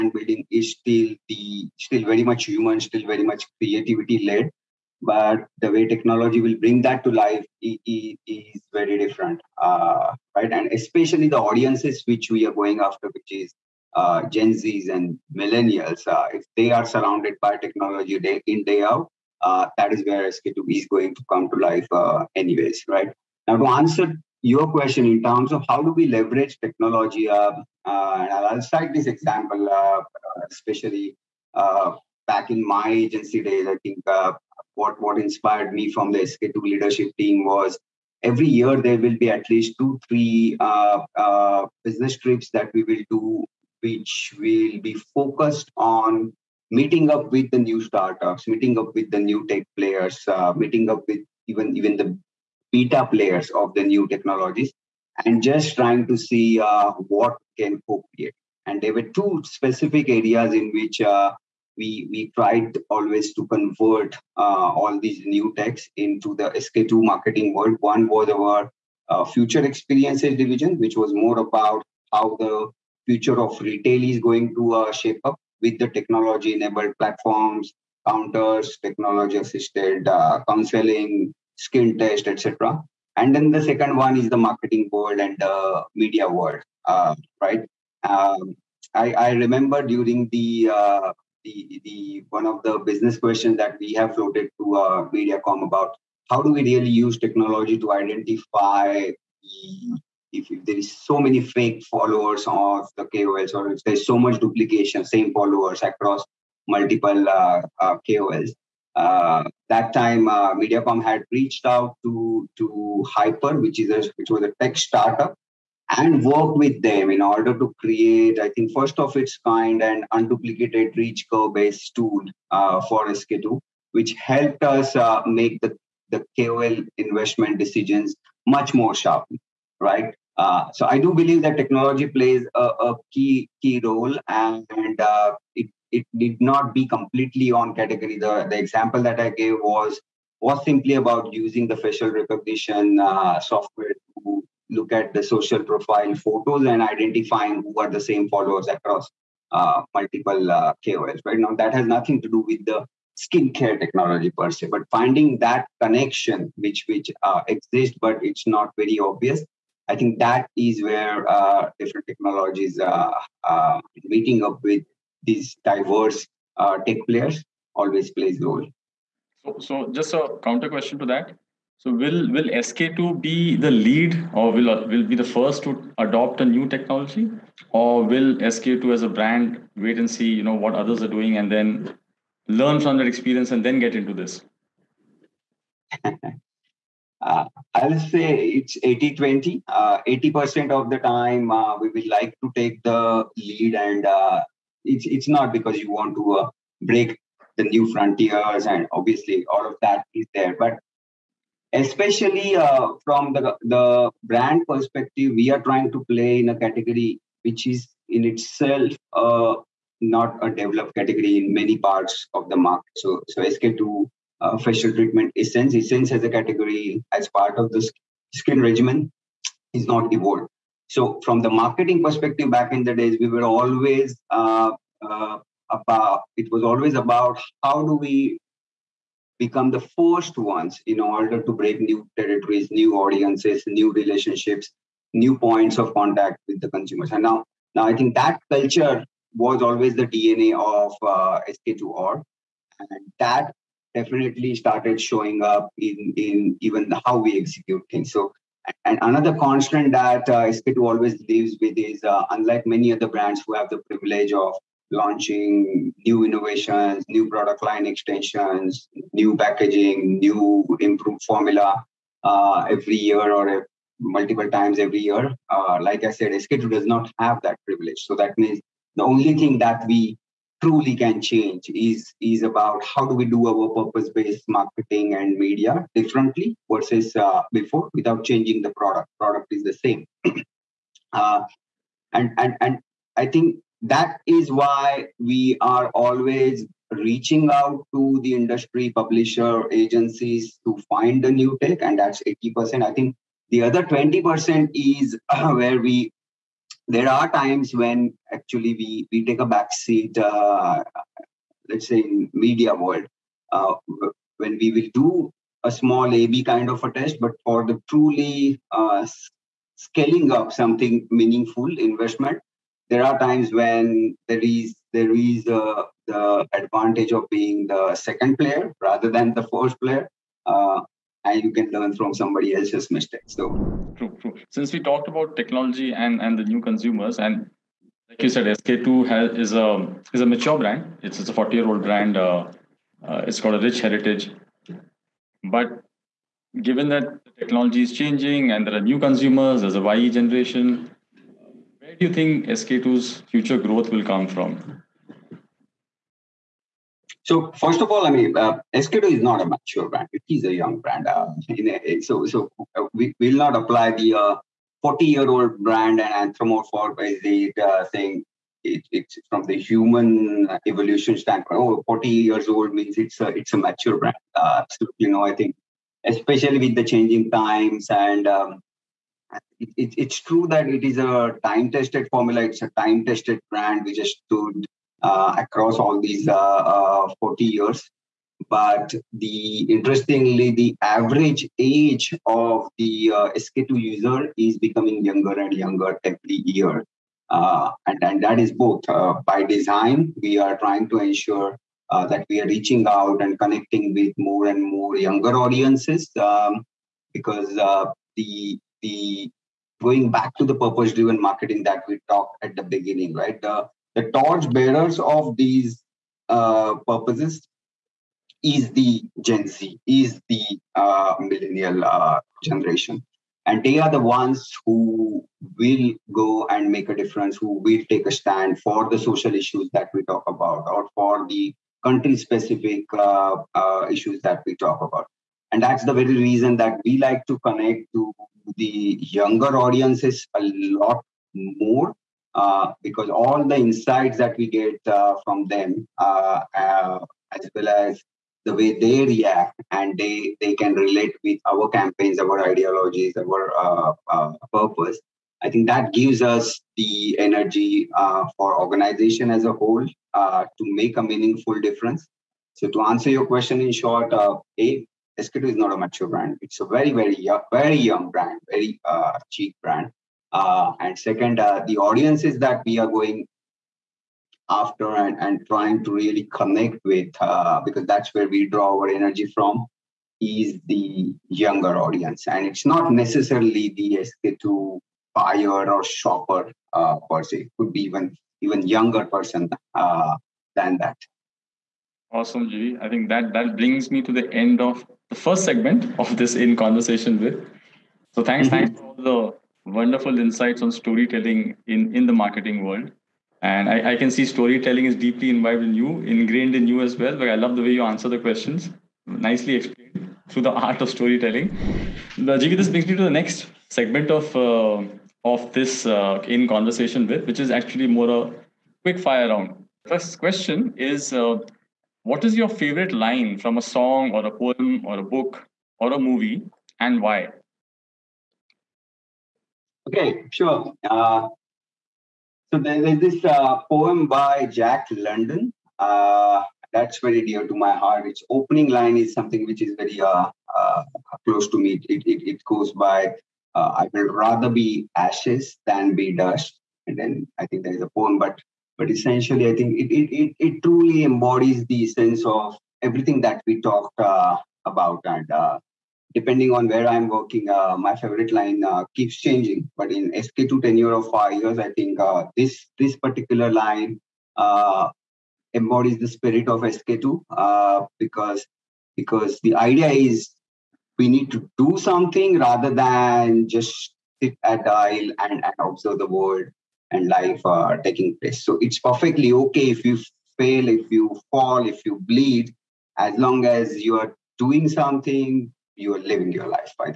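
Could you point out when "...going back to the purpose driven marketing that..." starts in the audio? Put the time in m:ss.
6:39.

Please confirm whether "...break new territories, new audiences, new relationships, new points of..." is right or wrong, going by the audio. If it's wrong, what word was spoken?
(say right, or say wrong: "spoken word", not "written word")
right.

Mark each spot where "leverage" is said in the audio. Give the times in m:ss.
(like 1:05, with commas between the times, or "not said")
0:26.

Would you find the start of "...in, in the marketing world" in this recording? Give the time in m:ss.
8:11.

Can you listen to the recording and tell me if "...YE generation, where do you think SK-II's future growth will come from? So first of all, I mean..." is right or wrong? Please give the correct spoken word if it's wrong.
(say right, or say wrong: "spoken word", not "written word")
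right.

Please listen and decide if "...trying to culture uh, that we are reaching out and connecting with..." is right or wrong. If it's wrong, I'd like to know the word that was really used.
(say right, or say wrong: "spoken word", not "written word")
wrong: "ensure", not "culture".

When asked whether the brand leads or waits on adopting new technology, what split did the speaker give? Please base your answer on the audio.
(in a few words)
80 20.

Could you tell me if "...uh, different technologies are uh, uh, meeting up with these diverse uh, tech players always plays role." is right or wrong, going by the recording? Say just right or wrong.
right.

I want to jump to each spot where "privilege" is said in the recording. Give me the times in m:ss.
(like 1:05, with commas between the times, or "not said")
4:13, 4:27.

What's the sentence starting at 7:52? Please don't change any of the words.
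And it's not necessarily the SK-II buyer or shopper uh, per se.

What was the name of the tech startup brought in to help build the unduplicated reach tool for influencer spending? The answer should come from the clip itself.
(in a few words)
Hyper.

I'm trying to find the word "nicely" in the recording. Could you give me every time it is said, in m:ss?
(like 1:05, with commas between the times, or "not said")
8:19.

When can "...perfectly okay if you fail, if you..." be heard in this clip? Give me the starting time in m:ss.
9:28.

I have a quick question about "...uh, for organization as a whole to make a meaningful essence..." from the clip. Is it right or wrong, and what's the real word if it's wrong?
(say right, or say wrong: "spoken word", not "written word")
wrong: "difference", not "essence".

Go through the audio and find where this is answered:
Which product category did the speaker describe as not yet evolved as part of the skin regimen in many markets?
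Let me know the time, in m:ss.
3:34.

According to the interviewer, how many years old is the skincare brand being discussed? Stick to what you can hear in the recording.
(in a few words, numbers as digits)
40.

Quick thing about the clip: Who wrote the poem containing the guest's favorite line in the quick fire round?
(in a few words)
Jack London.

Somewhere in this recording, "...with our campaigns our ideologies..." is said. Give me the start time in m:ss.
7:21.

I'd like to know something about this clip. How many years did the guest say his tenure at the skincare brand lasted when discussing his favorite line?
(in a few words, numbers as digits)
5.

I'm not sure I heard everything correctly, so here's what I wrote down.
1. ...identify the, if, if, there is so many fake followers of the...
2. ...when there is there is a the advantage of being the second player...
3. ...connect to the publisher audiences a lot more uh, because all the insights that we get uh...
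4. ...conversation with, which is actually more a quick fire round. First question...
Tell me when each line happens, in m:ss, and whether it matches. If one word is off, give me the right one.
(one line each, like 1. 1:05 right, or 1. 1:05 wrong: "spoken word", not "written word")
1. 1:37 right
2. 5:13 right
3. 7:07 wrong: "younger", not "publisher"
4. 8:26 right.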